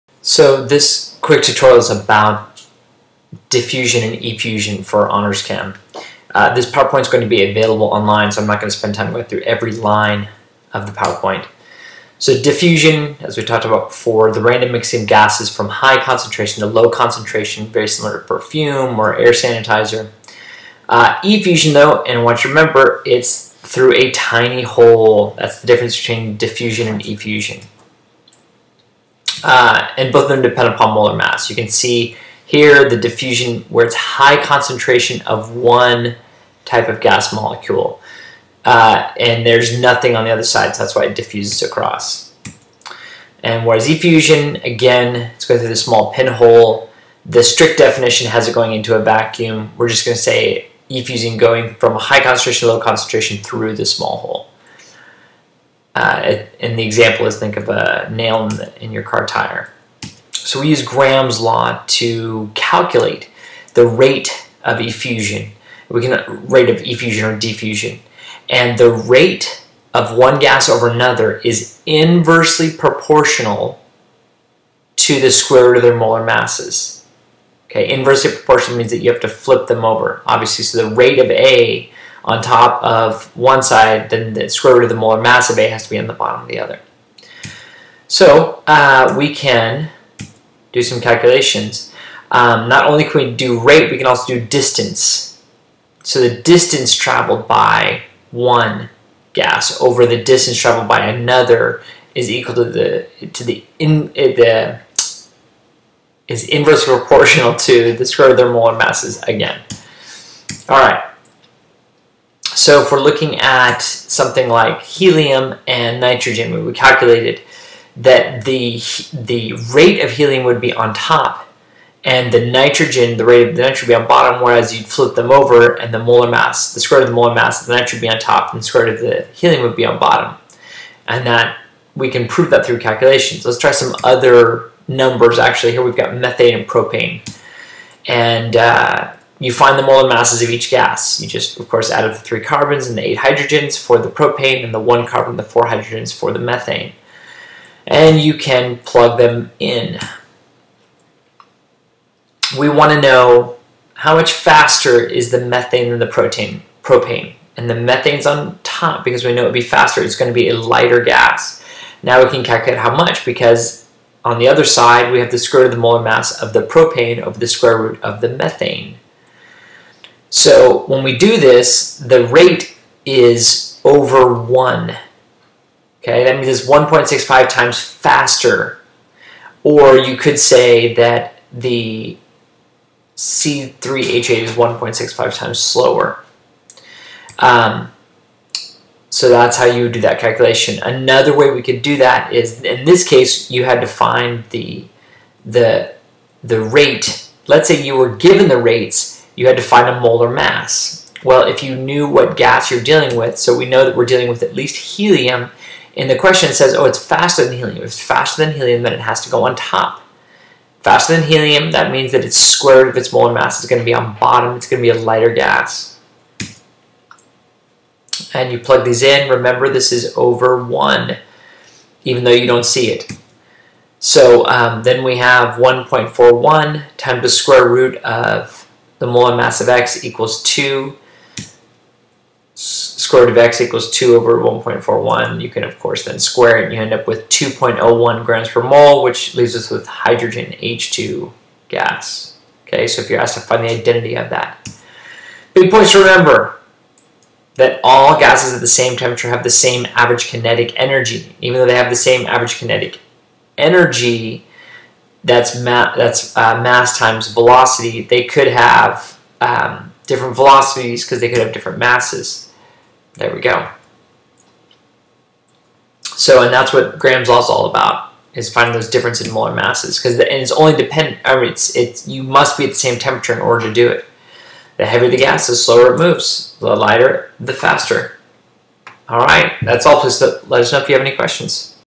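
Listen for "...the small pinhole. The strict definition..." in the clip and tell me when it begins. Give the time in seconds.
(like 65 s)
45 s.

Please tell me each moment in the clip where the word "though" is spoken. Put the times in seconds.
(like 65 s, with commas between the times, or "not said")
21 s, 222 s, 251 s.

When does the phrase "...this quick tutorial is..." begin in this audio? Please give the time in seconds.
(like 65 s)
0 s.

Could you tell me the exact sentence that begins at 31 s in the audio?
You can see here the diffusion where it's high concentration of one type of gas molecule.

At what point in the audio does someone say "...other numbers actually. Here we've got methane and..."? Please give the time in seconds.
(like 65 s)
134 s.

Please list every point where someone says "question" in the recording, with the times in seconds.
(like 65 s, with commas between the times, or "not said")
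206 s, 281 s.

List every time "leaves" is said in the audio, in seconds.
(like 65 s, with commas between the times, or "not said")
239 s.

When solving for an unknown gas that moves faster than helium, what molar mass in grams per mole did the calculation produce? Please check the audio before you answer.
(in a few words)
2.01 grams per mole.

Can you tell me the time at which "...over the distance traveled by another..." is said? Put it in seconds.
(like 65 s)
99 s.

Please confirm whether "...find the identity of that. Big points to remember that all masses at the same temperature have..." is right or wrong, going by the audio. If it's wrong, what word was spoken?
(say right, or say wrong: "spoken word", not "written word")
wrong: "gases", not "masses".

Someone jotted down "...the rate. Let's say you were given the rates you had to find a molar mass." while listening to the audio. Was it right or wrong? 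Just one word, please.
right.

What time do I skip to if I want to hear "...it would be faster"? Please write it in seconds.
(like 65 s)
159 s.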